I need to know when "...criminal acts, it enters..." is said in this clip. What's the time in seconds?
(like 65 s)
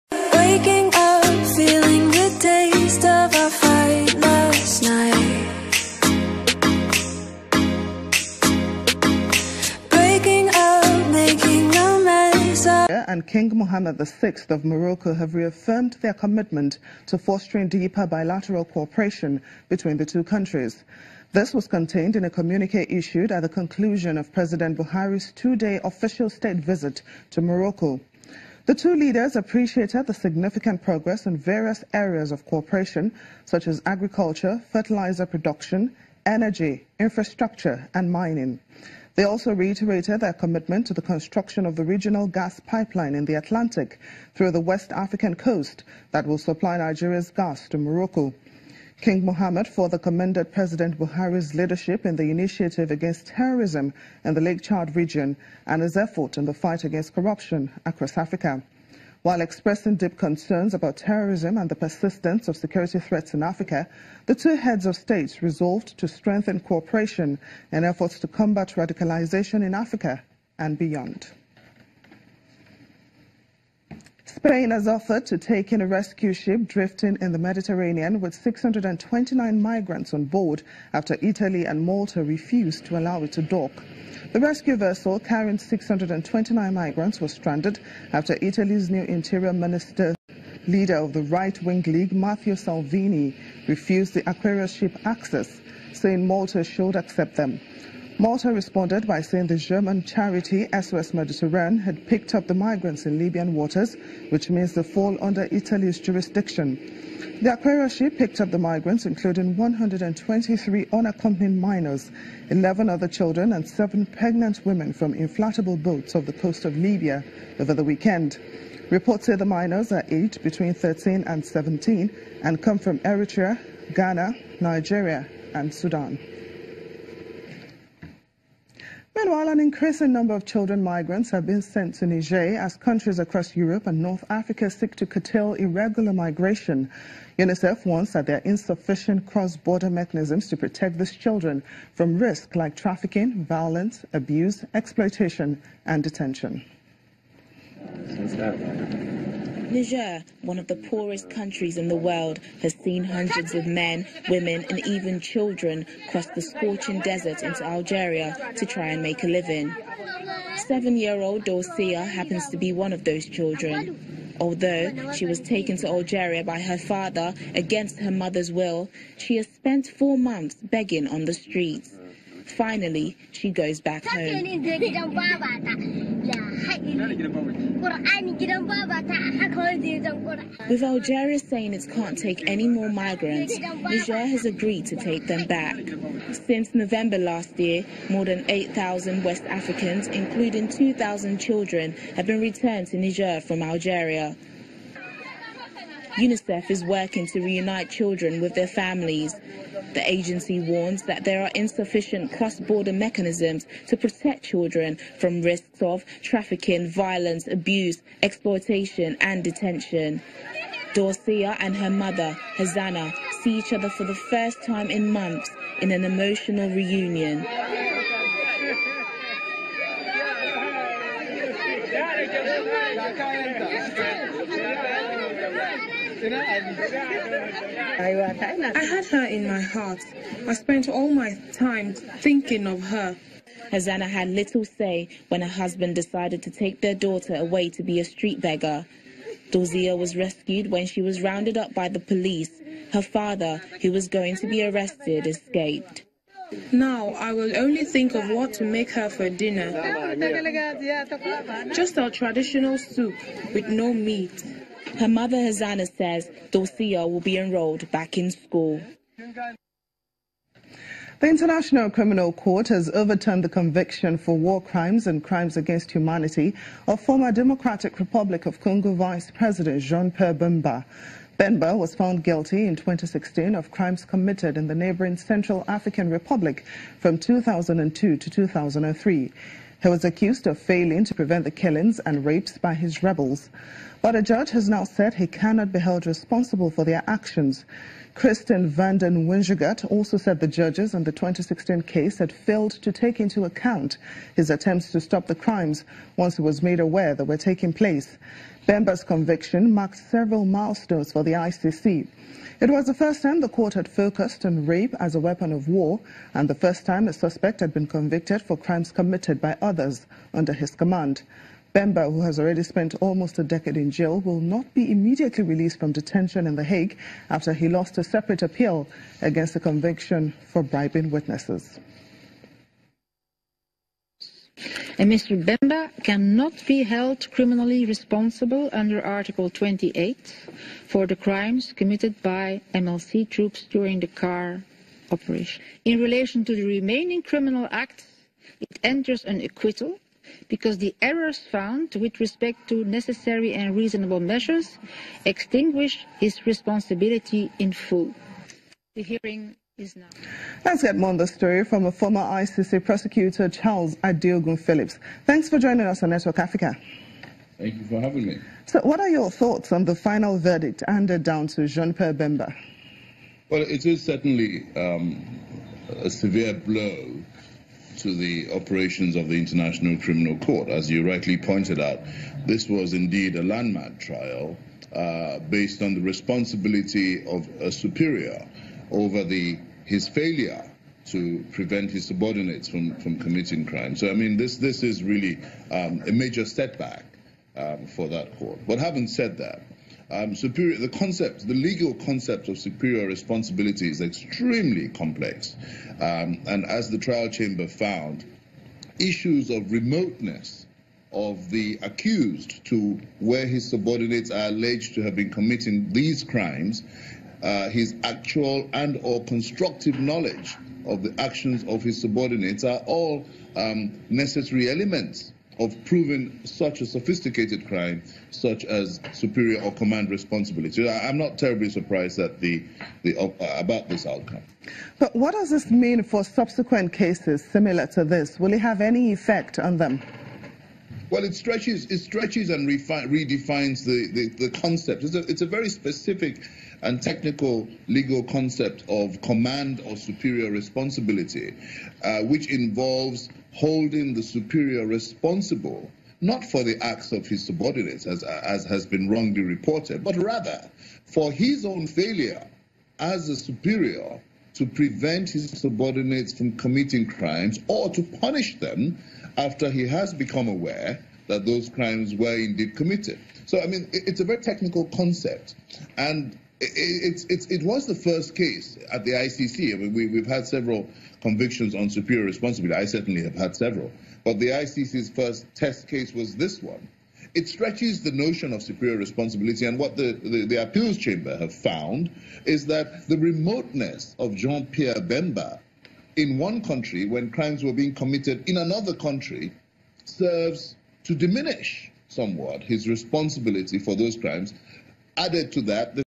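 337 s.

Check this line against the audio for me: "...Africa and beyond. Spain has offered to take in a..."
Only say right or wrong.
right.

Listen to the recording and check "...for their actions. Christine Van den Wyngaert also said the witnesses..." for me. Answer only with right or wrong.
wrong.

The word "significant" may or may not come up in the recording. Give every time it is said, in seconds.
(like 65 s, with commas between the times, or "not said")
30 s.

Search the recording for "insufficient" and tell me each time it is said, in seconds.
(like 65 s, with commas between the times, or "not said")
138 s, 201 s.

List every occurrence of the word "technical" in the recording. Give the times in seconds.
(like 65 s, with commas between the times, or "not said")
437 s, 464 s.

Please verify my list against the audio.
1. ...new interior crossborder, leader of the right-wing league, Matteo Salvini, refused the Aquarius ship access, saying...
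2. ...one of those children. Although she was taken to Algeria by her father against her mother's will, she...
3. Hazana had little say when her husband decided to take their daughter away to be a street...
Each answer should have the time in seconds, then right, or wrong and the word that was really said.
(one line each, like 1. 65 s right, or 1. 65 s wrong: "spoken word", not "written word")
1. 88 s wrong: "minister", not "crossborder"
2. 162 s right
3. 233 s right.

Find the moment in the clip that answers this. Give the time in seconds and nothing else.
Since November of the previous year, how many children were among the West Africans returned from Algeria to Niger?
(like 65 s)
190 s.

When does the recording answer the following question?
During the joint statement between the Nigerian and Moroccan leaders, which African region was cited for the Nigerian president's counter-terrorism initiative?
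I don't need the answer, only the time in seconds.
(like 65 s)
54 s.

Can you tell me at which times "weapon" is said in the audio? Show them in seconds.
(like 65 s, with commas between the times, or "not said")
305 s.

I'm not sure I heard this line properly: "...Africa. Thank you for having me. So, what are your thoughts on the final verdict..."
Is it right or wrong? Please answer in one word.
right.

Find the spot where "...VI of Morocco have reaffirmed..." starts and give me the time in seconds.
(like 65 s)
13 s.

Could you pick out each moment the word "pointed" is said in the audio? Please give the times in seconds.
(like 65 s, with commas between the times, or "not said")
371 s.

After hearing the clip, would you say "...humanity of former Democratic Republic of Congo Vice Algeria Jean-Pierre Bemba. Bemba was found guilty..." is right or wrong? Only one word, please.
wrong.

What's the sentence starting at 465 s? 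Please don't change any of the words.
And it, it's, it, was the first case at the ICC.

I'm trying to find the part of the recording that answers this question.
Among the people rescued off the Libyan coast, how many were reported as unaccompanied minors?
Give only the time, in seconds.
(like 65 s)
109 s.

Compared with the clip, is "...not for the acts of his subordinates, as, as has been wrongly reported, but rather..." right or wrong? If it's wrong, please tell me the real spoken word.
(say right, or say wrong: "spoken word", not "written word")
right.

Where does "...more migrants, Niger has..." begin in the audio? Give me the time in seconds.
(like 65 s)
182 s.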